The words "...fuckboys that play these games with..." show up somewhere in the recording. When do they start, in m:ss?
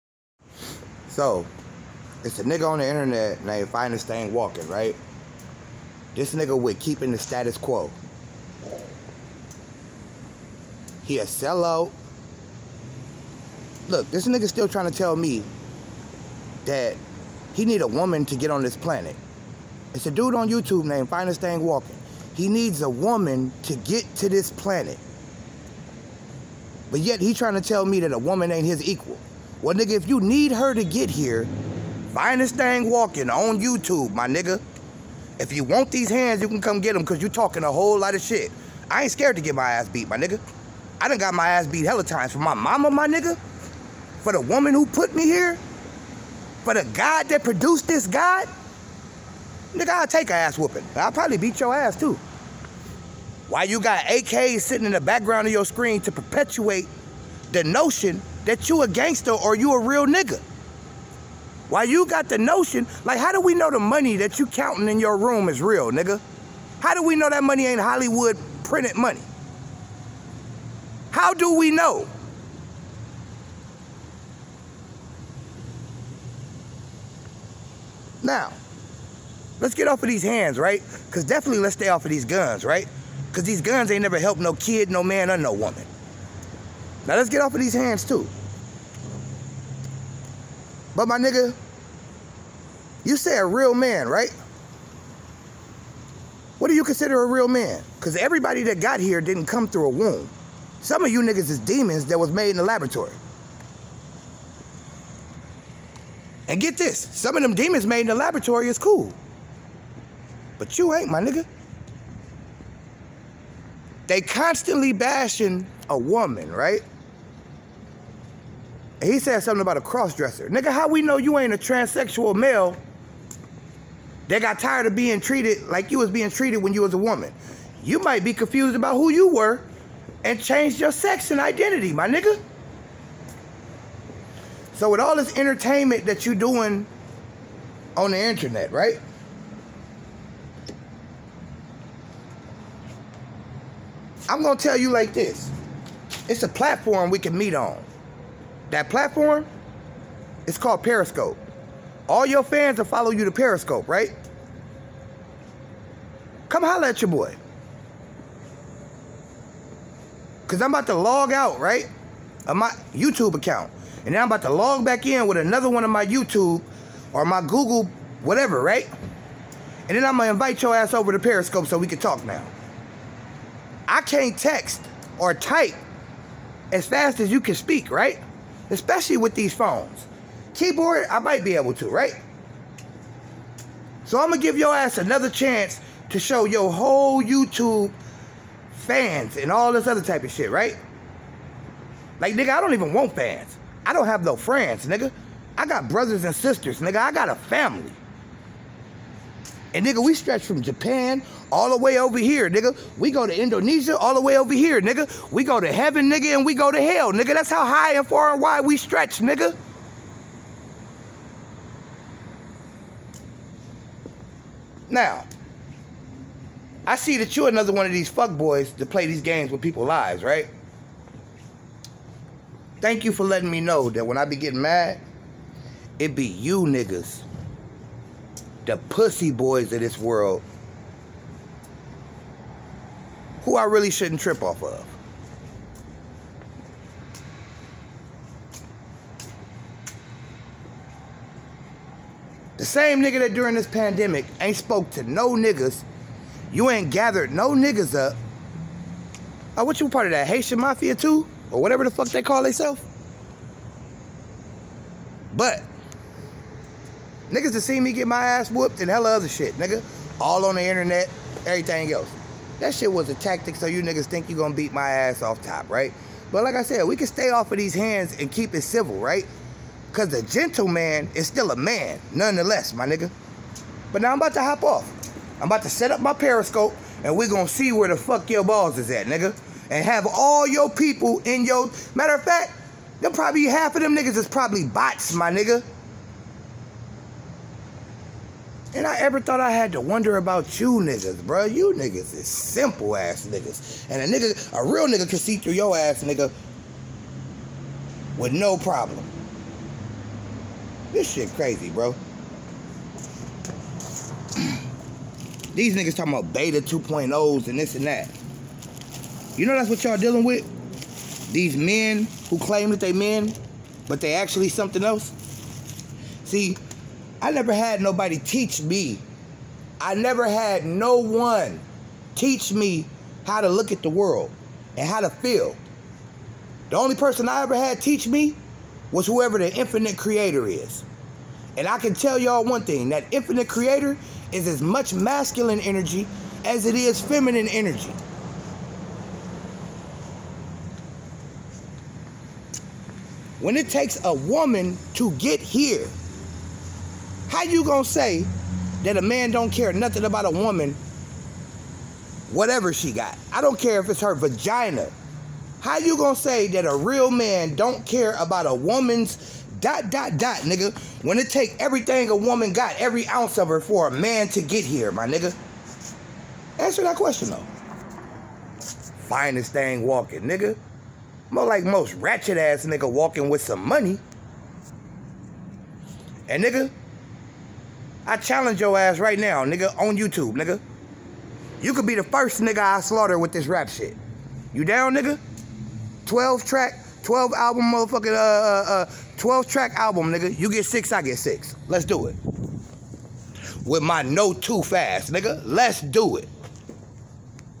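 3:38.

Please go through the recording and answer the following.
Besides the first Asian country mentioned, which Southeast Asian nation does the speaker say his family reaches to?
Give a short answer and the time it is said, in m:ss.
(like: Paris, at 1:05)
Indonesia, at 3:23.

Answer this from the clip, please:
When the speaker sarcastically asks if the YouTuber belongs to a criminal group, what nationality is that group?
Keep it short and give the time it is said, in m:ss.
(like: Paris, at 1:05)
Haitian, at 4:10.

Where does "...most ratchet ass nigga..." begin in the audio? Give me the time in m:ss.
6:11.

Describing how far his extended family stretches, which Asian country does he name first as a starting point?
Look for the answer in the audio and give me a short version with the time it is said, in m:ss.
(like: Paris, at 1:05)
Japan, at 3:20.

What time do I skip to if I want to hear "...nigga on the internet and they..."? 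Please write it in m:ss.
0:02.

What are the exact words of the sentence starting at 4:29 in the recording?
Cause the gentleman is still a man, nonetheless, my nigga.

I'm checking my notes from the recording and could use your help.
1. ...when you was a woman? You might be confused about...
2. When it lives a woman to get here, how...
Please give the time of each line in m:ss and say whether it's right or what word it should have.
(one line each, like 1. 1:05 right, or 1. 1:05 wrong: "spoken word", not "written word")
1. 2:06 right
2. 5:43 wrong: "takes", not "lives".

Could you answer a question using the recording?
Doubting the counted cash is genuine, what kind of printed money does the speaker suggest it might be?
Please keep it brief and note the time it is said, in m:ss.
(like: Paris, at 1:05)
Hollywood printed money, at 1:07.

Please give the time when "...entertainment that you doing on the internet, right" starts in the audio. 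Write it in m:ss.
2:15.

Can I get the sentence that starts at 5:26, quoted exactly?
The only person I ever had teach me was whoever the infinite creator is.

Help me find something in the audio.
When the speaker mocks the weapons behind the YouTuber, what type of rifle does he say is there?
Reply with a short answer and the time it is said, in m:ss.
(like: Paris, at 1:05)
AKs, at 0:54.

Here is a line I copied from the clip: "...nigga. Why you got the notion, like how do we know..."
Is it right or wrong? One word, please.
right.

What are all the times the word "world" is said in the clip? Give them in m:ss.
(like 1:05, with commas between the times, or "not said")
3:49, 5:23.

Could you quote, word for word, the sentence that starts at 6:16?
And nigga, I challenge your ass right now, nigga, on YouTube, nigga.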